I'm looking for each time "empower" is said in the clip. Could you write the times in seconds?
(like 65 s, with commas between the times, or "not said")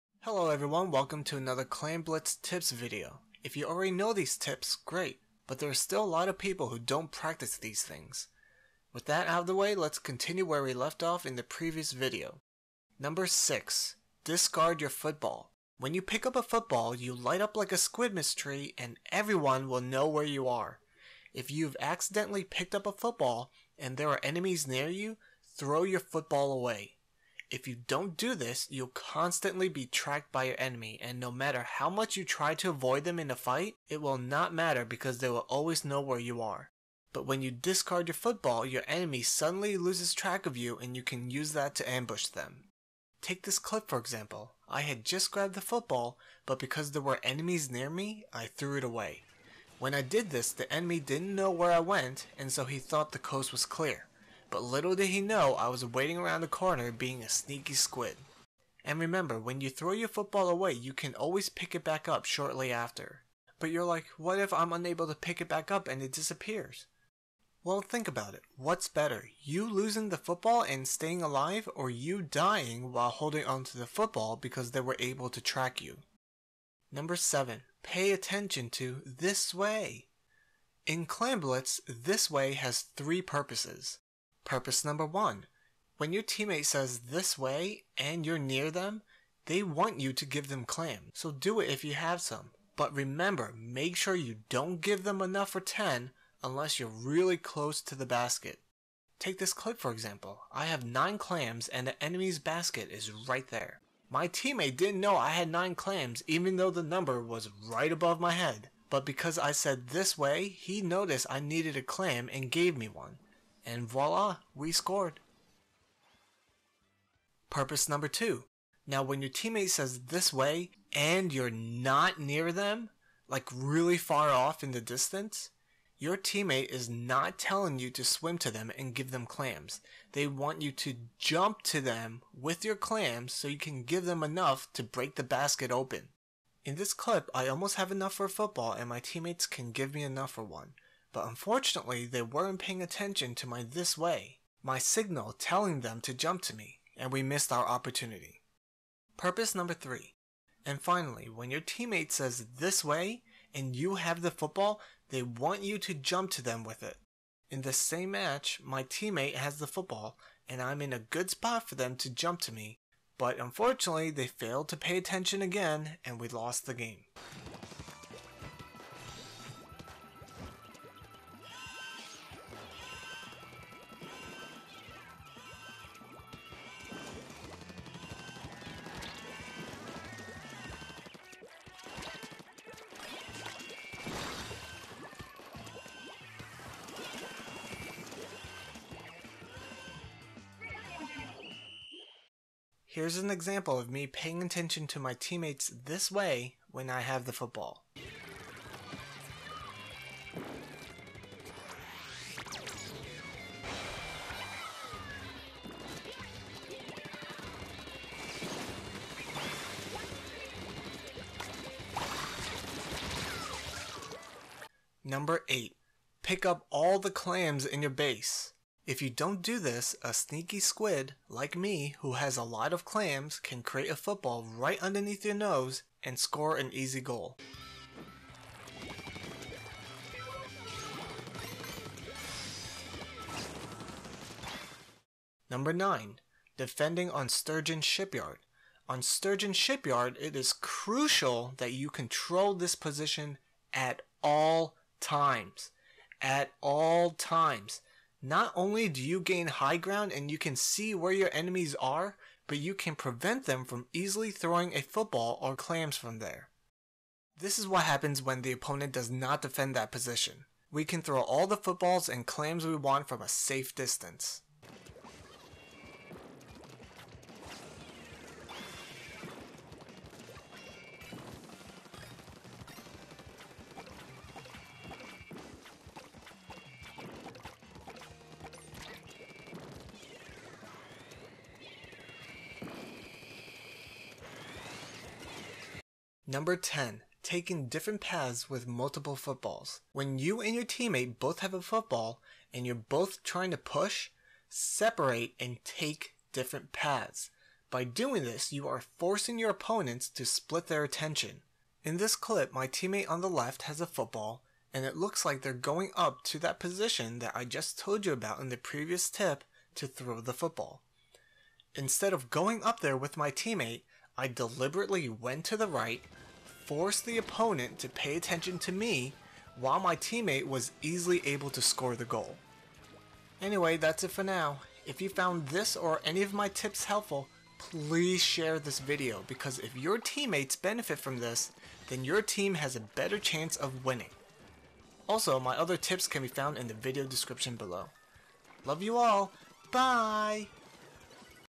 not said.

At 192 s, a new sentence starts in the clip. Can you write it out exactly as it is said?
Here's an example of me paying attention to my teammates this way when I have the football.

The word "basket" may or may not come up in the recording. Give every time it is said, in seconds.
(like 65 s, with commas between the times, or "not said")
98 s, 102 s, 135 s.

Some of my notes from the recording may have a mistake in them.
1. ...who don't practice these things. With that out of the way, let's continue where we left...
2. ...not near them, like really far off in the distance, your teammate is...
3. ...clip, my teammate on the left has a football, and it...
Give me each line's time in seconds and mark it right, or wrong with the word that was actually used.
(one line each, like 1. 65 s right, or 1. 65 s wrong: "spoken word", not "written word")
1. 6 s right
2. 121 s right
3. 302 s right.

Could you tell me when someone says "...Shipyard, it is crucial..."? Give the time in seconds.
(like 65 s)
239 s.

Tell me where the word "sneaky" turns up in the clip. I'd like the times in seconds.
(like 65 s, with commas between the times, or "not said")
57 s, 220 s.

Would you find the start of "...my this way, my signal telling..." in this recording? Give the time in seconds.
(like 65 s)
143 s.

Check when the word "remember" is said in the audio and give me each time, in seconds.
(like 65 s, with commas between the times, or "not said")
58 s, 92 s.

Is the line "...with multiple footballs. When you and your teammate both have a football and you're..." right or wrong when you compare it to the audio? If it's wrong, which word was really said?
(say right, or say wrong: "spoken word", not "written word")
right.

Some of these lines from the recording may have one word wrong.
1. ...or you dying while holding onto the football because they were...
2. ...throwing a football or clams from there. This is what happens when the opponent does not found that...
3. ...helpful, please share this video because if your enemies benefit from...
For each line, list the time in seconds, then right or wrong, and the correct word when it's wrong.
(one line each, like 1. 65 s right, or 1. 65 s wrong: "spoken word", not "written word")
1. 71 s right
2. 254 s wrong: "defend", not "found"
3. 326 s wrong: "teammates", not "enemies".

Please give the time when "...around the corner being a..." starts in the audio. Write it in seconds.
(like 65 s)
56 s.